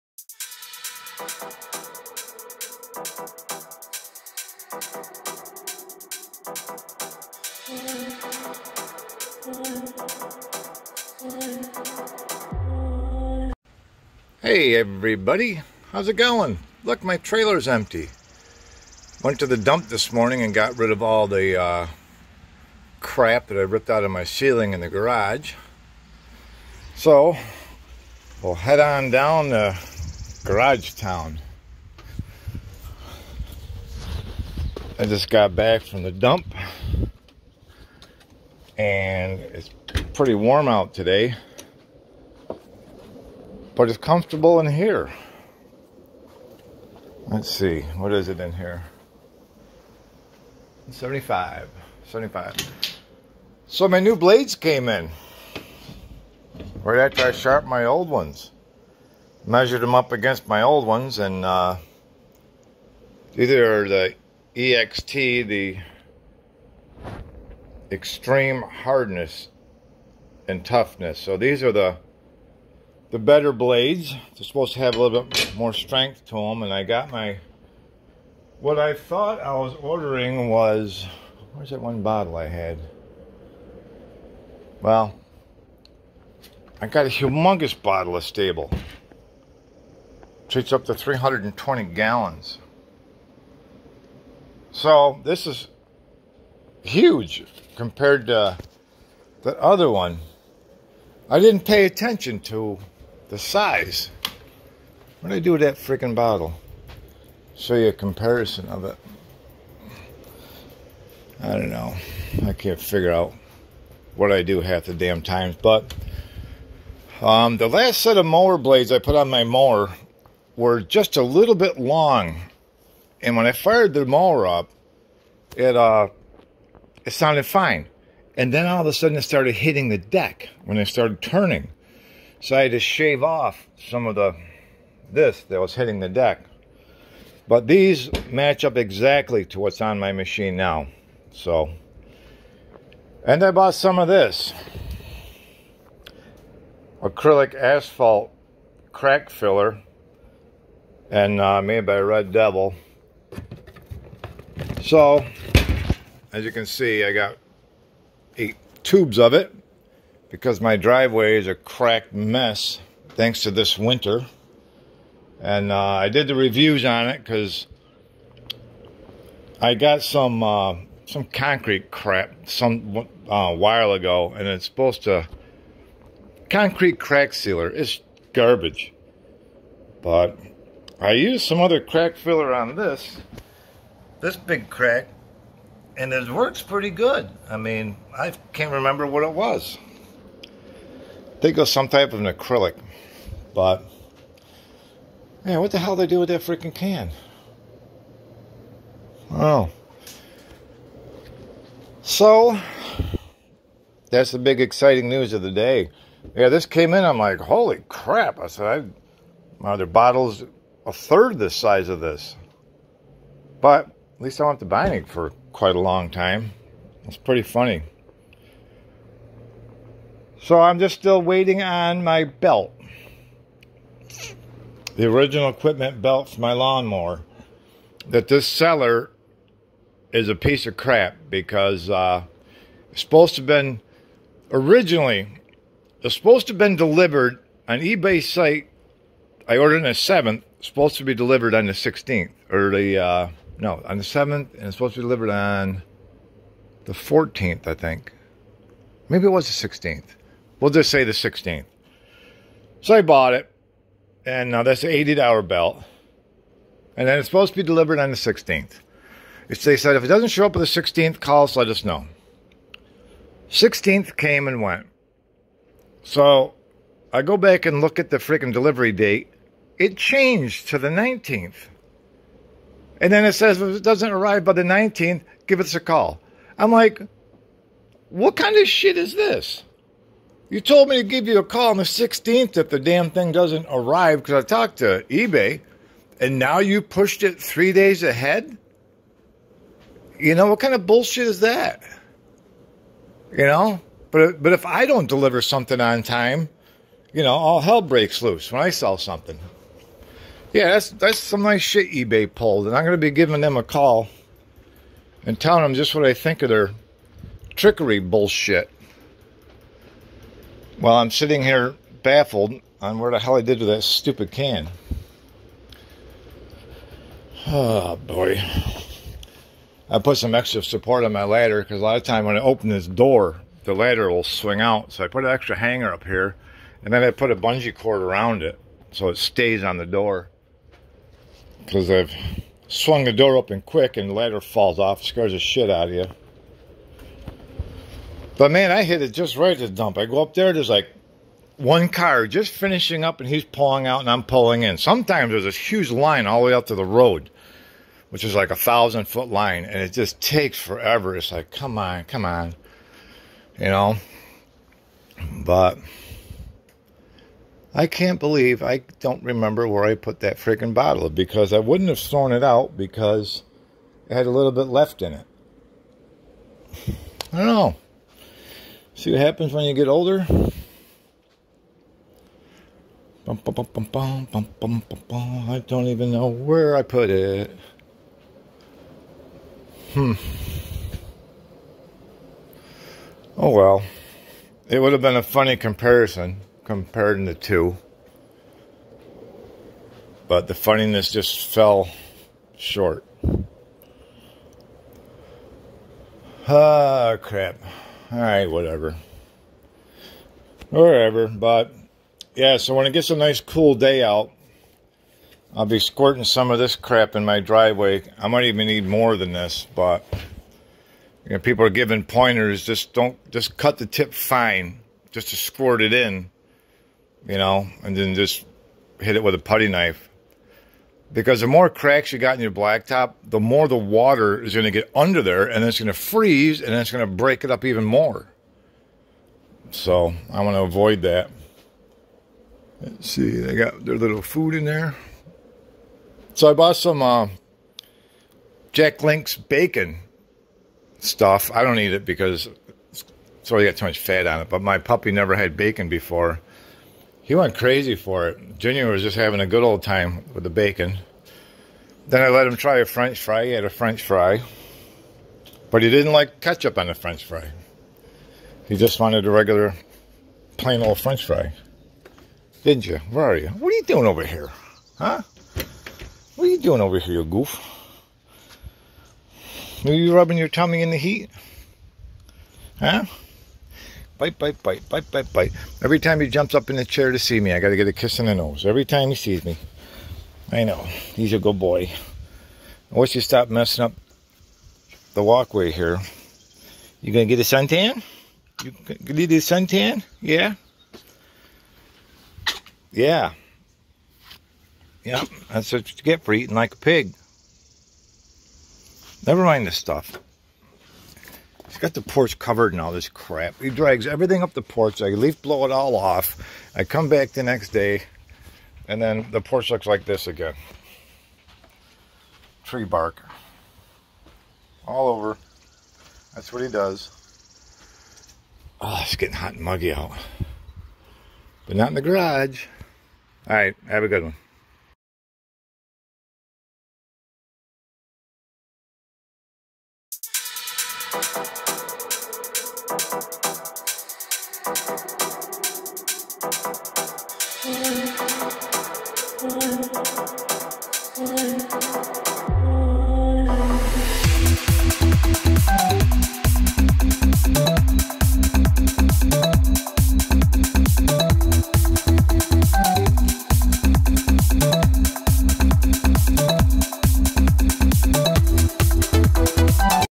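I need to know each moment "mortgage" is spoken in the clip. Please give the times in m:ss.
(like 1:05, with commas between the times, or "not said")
not said.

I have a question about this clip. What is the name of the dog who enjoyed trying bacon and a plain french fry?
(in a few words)
Junior.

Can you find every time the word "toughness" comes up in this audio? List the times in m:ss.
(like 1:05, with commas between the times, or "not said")
1:10.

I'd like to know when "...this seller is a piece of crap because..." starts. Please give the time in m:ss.
3:48.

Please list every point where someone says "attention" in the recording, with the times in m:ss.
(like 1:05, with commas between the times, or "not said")
1:41.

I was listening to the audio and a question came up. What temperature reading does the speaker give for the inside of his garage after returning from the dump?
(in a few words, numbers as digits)
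75.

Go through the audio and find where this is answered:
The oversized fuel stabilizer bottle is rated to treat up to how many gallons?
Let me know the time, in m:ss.
1:30.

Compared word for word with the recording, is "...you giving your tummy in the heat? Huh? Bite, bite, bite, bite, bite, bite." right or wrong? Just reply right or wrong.
wrong.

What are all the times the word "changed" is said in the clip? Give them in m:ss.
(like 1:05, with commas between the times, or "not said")
4:29.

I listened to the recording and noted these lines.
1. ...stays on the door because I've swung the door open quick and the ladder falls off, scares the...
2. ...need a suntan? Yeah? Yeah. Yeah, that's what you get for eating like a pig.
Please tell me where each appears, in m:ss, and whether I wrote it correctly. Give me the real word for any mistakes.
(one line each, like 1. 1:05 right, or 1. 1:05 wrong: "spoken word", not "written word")
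1. 5:29 right
2. 8:09 right.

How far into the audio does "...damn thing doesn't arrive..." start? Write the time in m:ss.
4:42.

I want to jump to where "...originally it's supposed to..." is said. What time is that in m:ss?
3:54.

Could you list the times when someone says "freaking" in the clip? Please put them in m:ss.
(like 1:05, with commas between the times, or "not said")
1:45, 3:16, 4:28, 6:00.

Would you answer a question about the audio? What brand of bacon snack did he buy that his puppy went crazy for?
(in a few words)
Jack Link's.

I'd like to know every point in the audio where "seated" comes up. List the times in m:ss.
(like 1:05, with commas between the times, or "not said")
not said.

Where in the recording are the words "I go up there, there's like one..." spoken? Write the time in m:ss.
5:39.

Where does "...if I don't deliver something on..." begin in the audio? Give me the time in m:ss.
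4:54.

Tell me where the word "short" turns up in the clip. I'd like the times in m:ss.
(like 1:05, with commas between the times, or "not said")
6:32.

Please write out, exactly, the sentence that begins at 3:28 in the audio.
I said, I, are there bottles a third the size of this.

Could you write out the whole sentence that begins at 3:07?
I mean, I can't remember what it was.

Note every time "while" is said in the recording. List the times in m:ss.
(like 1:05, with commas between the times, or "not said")
2:53, 5:10.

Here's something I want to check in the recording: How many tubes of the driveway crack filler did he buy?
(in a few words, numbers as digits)
8.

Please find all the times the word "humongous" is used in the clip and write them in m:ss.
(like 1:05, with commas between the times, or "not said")
1:27.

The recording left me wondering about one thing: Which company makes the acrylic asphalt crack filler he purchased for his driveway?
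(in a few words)
Red Devil.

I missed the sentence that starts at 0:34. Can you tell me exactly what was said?
I just got back from the dump and it's pretty warm out today, but it's comfortable in here.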